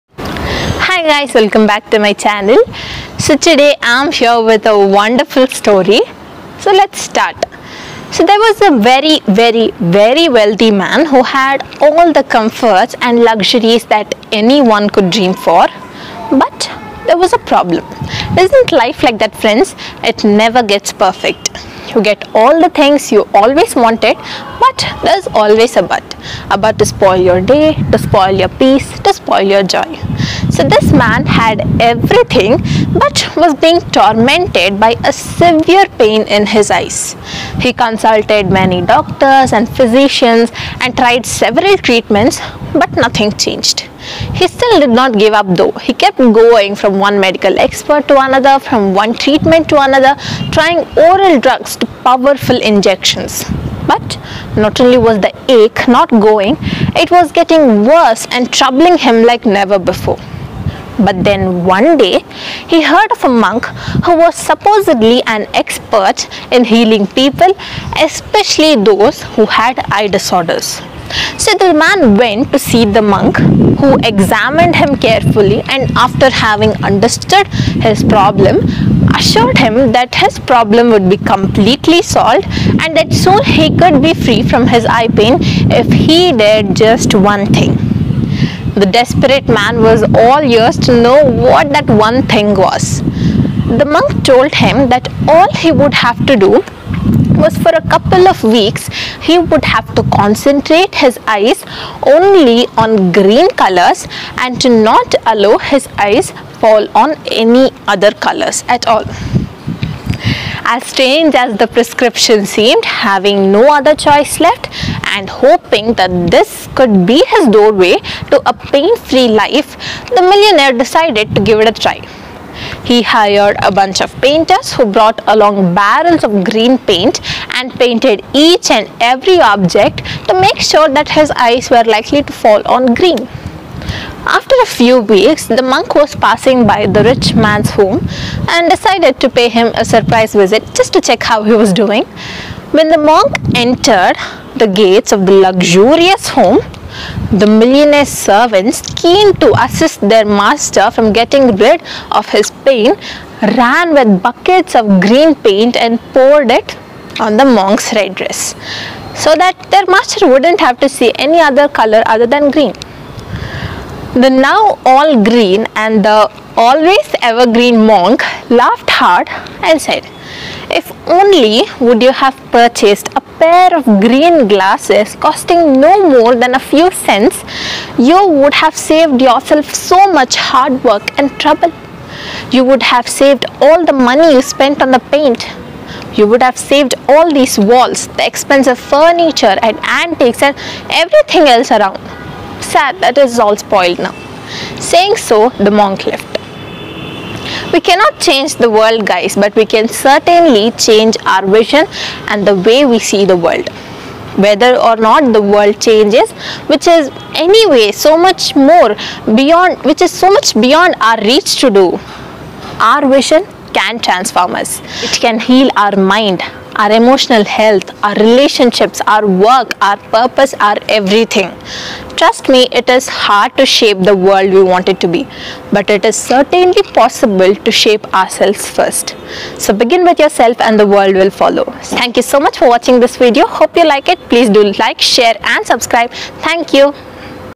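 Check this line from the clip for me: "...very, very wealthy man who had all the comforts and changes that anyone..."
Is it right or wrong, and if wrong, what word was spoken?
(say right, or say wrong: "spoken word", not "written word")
wrong: "luxuries", not "changes".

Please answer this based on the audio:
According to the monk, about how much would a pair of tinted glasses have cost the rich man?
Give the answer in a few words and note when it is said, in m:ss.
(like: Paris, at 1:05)
A few cents, at 2:56.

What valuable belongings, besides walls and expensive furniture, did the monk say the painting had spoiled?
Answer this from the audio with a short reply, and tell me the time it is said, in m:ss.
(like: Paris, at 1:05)
Antiques, at 3:09.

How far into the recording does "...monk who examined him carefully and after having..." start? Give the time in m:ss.
1:13.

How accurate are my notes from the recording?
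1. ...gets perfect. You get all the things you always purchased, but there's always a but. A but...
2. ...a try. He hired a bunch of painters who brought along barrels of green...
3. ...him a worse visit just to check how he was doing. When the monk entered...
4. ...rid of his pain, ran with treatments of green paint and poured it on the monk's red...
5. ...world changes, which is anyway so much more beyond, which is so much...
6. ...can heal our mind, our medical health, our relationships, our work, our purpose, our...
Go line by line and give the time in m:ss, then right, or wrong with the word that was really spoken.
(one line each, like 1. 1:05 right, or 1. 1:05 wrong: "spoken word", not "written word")
1. 0:20 wrong: "wanted", not "purchased"
2. 2:01 right
3. 2:19 wrong: "surprise", not "worse"
4. 2:31 wrong: "buckets", not "treatments"
5. 3:25 right
6. 3:35 wrong: "emotional", not "medical".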